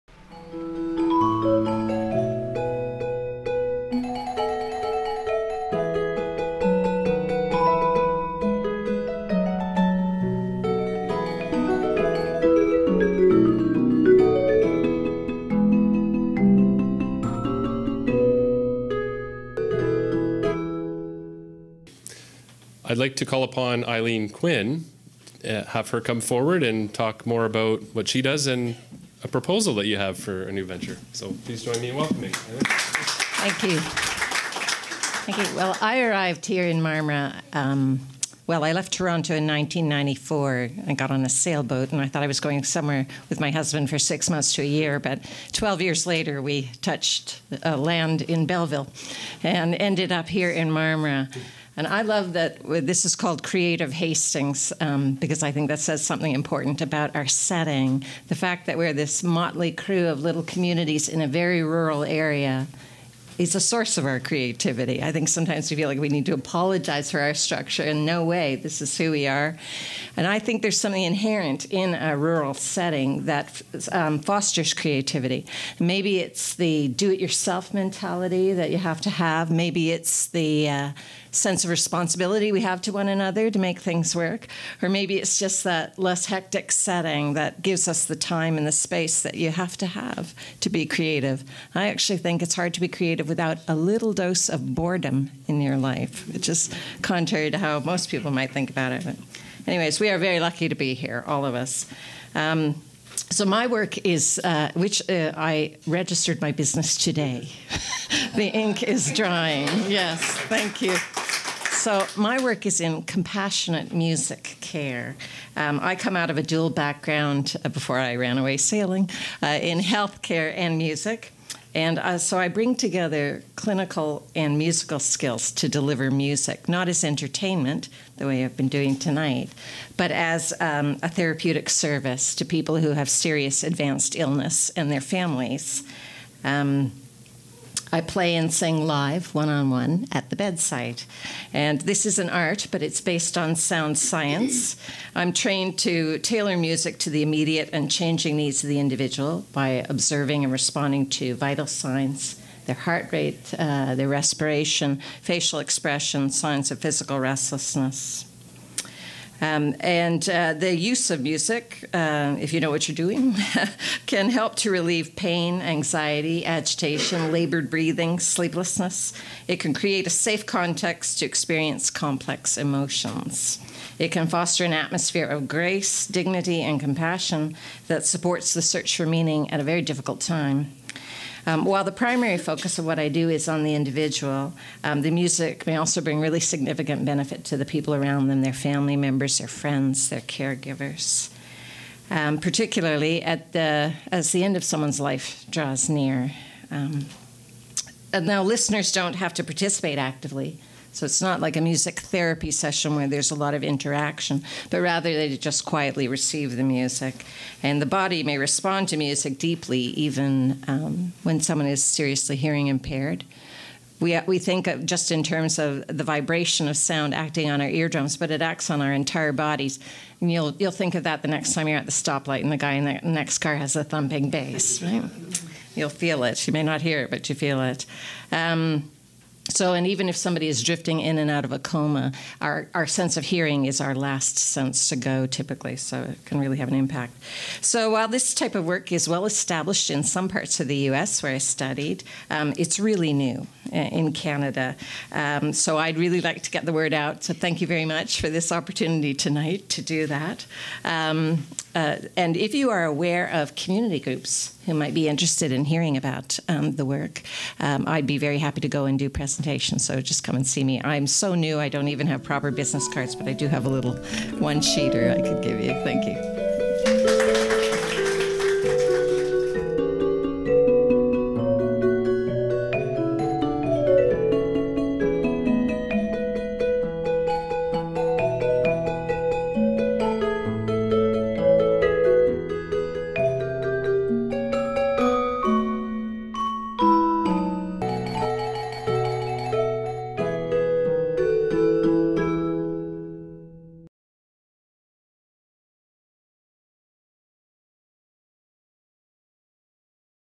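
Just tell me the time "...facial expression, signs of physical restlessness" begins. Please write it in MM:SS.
02:35.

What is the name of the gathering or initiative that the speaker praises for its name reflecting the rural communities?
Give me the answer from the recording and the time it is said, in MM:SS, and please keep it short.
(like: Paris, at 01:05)
Creative Hastings, at 00:53.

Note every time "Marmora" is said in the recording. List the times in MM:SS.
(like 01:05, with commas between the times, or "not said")
00:36, 00:50.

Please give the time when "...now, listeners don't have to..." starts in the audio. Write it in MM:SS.
03:18.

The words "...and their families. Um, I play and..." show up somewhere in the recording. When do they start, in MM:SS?
02:14.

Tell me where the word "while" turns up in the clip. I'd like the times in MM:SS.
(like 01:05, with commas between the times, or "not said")
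03:01, 03:57.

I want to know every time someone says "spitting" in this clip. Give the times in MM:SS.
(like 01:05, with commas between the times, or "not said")
not said.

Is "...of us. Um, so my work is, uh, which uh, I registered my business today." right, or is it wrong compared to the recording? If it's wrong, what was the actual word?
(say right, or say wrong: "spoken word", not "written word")
right.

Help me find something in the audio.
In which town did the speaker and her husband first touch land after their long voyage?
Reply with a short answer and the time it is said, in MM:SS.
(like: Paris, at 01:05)
Belleville, at 00:48.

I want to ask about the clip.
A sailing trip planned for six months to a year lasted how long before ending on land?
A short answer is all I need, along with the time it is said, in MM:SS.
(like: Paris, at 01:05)
12 years, at 00:45.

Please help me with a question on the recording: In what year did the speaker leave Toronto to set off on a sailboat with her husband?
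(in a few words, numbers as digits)
1994.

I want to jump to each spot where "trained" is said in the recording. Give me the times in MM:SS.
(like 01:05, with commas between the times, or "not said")
02:25.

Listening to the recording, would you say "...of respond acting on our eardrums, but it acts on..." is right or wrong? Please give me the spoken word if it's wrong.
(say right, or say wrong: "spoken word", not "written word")
wrong: "sound", not "respond".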